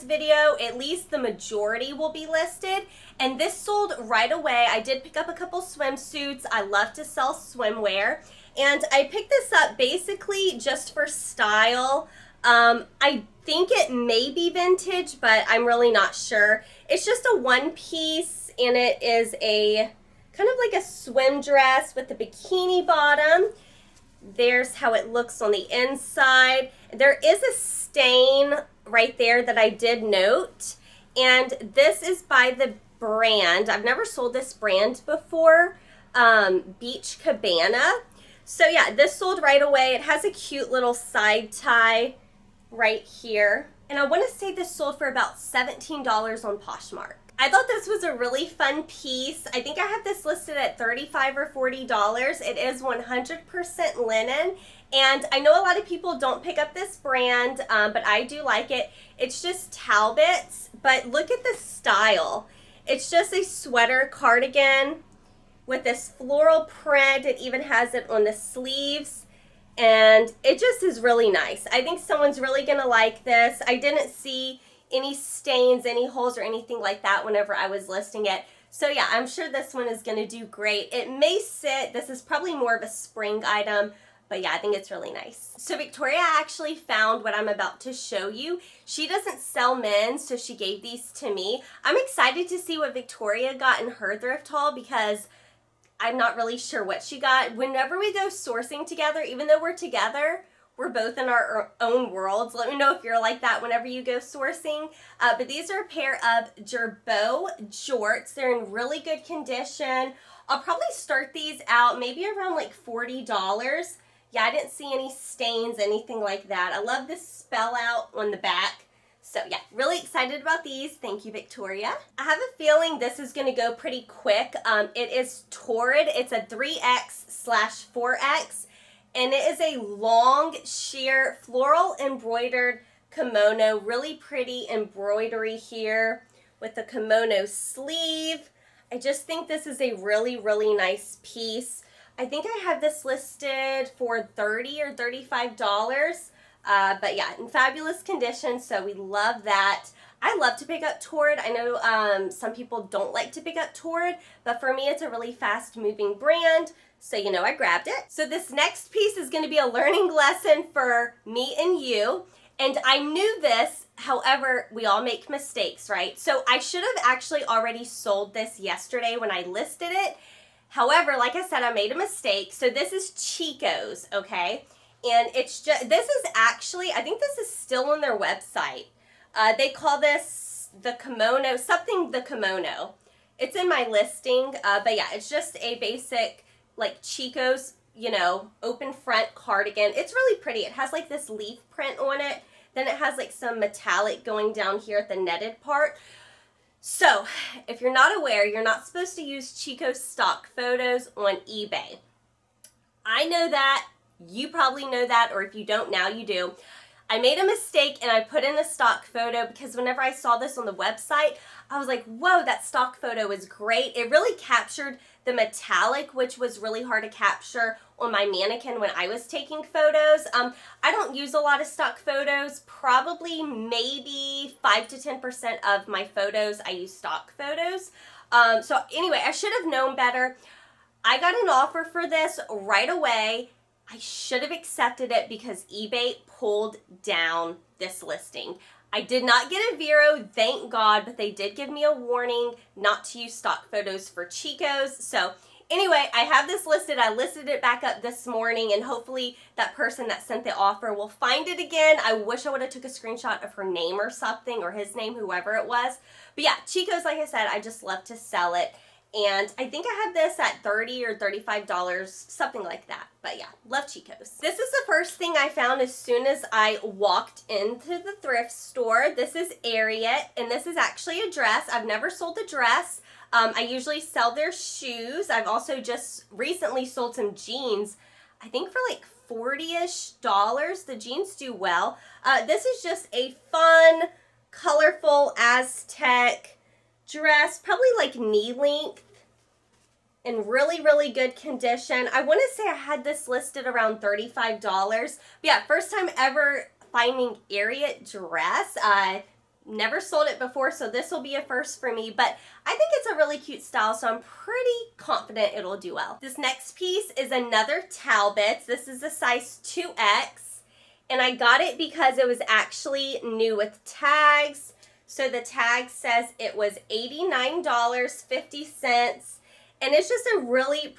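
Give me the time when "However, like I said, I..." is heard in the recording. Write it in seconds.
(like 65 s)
170 s.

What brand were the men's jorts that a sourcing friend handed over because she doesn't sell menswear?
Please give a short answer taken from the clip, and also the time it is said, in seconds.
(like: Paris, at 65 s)
Girbaud, at 106 s.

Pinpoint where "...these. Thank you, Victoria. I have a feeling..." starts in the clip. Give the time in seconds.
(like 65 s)
120 s.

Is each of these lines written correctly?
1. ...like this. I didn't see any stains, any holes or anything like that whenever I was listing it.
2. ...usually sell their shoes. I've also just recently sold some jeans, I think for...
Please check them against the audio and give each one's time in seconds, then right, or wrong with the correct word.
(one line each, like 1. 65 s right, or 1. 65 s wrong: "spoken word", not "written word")
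1. 72 s right
2. 273 s right.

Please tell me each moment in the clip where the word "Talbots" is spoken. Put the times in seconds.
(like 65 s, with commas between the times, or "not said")
59 s, 307 s.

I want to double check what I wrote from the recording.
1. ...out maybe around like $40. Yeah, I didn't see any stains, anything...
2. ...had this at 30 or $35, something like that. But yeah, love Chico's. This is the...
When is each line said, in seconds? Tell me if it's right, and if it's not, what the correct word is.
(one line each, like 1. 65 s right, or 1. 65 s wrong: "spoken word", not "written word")
1. 111 s right
2. 260 s right.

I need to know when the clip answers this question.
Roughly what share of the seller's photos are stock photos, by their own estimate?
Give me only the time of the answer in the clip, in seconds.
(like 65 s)
224 s.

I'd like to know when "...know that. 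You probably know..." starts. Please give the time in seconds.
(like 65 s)
203 s.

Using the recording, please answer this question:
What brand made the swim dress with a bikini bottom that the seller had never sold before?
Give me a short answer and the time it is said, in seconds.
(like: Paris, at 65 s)
Beach Cabana, at 36 s.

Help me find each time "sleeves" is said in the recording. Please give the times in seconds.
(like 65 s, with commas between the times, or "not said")
68 s, 137 s.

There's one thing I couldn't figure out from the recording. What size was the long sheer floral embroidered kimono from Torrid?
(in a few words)
3X/4X.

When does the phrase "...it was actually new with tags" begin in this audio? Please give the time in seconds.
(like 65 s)
312 s.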